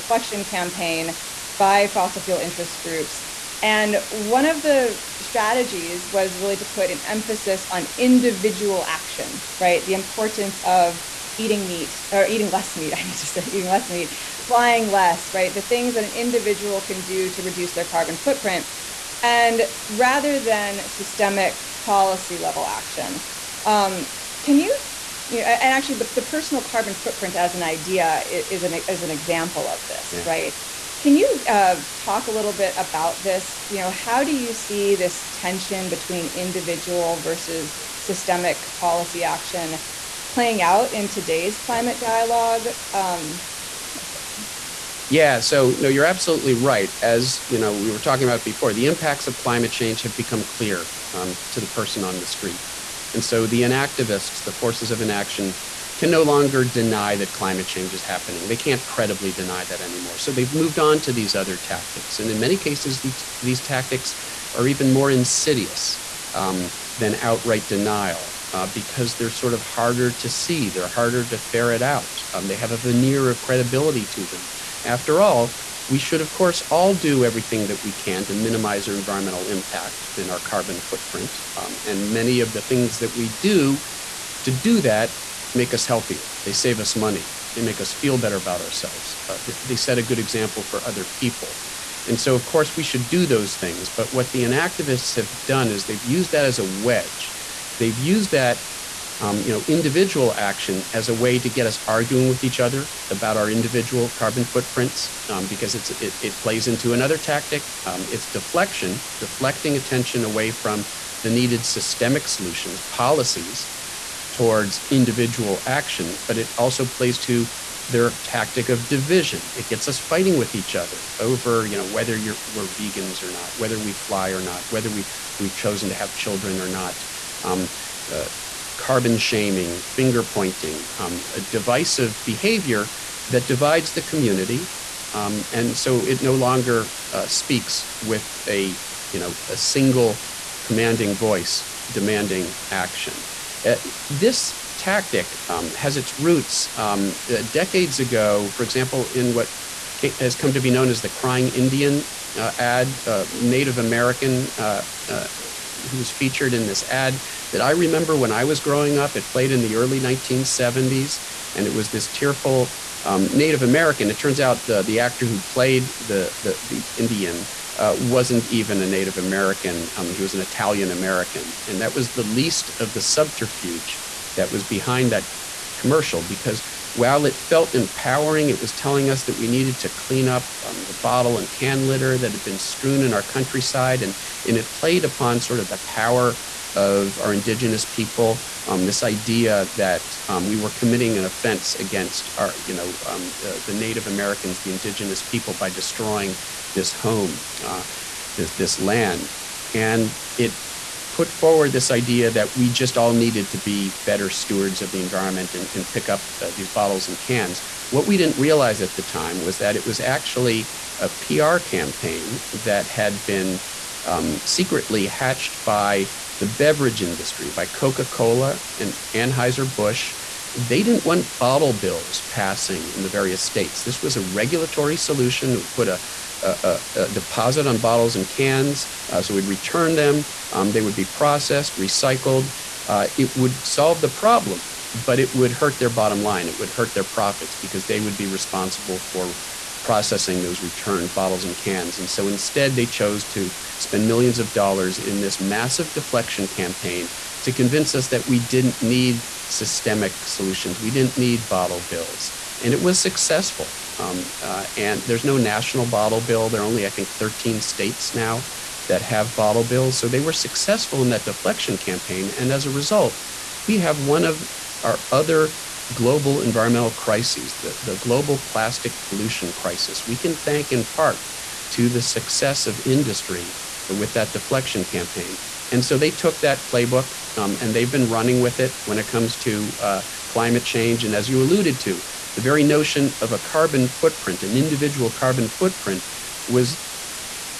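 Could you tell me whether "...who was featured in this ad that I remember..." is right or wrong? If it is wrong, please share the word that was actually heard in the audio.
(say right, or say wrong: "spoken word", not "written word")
right.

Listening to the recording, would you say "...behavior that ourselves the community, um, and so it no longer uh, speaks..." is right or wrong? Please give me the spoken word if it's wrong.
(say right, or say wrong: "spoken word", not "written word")
wrong: "divides", not "ourselves".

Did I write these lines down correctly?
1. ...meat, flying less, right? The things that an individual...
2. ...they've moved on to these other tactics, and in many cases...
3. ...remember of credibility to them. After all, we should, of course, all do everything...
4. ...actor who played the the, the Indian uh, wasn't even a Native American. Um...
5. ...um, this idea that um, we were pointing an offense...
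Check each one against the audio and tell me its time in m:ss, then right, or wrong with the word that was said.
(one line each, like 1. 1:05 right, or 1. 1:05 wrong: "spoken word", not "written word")
1. 0:13 right
2. 1:00 right
3. 1:12 wrong: "veneer", not "remember"
4. 2:44 right
5. 3:08 wrong: "committing", not "pointing".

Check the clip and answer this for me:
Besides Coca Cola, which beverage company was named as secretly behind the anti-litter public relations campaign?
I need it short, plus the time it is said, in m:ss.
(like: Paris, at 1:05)
Anheuser-Busch, at 3:39.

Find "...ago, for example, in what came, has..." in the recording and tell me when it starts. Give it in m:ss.
2:27.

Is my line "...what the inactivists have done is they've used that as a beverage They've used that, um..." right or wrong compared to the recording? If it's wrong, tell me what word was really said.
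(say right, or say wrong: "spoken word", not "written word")
wrong: "wedge", not "beverage".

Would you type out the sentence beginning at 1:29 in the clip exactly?
Uh, they set a good example for other people.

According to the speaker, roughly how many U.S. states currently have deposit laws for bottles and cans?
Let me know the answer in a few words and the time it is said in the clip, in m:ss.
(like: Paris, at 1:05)
13, at 4:17.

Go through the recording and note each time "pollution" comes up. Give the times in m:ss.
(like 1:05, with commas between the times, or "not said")
4:29.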